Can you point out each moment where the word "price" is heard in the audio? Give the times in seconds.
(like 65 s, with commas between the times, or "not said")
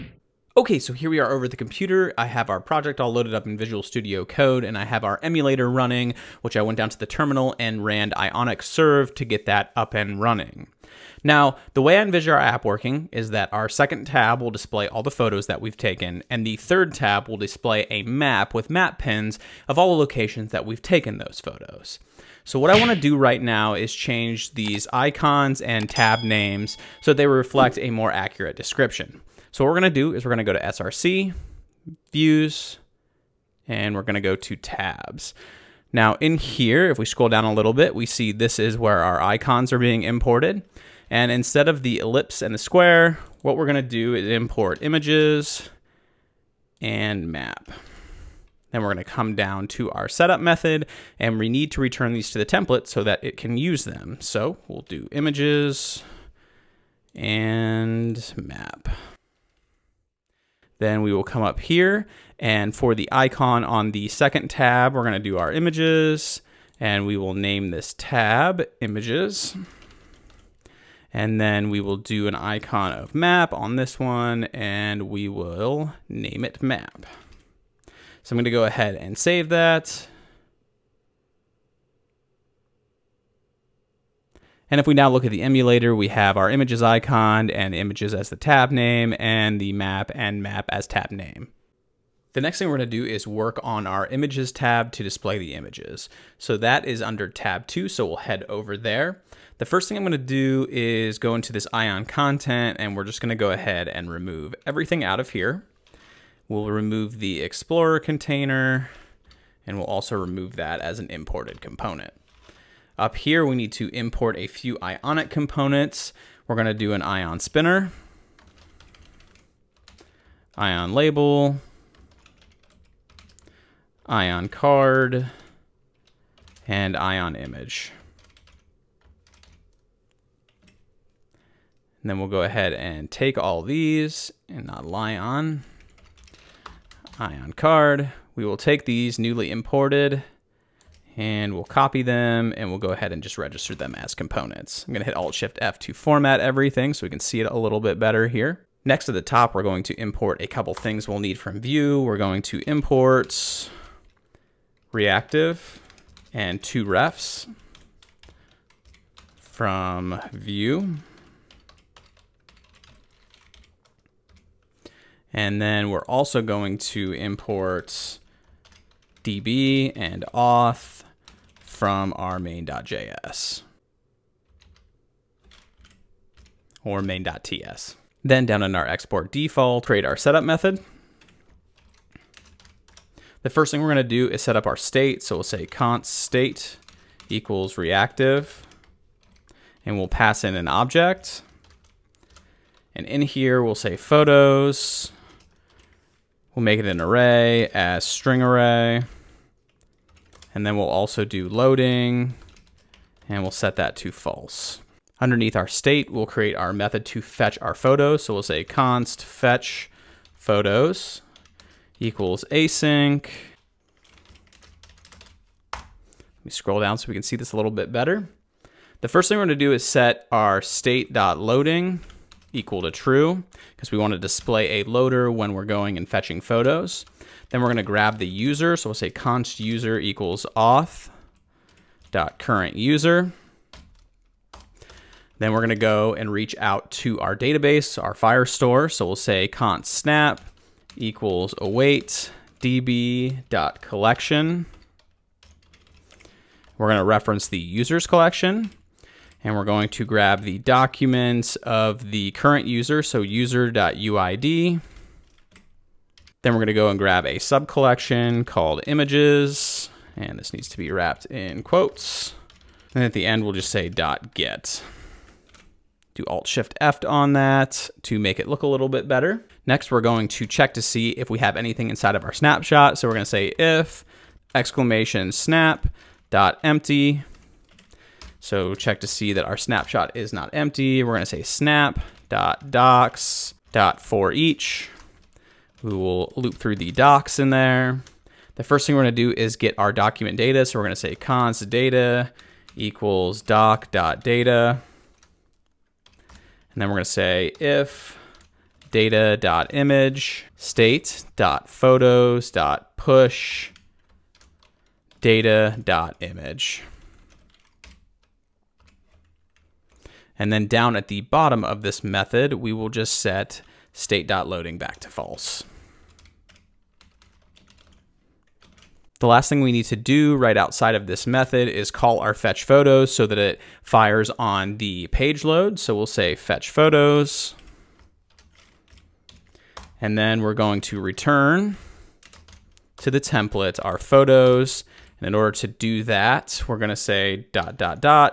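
not said.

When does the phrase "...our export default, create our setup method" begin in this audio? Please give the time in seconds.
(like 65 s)
178 s.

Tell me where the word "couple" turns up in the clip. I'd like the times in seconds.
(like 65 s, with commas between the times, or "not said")
150 s.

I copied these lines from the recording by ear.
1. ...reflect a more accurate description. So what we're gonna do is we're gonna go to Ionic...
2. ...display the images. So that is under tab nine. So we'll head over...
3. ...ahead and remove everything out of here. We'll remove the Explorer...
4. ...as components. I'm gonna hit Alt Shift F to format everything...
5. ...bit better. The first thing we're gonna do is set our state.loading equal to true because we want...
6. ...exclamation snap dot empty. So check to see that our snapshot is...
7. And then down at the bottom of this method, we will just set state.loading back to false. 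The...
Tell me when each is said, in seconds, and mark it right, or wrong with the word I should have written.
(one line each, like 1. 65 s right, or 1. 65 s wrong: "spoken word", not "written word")
1. 27 s wrong: "SRC", not "Ionic"
2. 95 s wrong: "two", not "nine"
3. 103 s right
4. 143 s right
5. 217 s right
6. 274 s right
7. 310 s right.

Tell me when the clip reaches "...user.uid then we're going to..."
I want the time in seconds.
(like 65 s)
253 s.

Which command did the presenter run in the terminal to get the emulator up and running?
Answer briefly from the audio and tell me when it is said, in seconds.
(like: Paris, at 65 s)
Ionic Serve, at 8 s.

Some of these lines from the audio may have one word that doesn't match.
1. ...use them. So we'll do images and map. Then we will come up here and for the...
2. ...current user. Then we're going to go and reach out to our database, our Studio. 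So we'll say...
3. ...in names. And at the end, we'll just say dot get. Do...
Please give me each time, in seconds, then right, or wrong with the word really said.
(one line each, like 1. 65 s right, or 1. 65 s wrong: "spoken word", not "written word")
1. 53 s right
2. 232 s wrong: "Firestore", not "Studio"
3. 261 s wrong: "quotes", not "names".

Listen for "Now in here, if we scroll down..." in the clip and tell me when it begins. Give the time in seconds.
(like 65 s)
35 s.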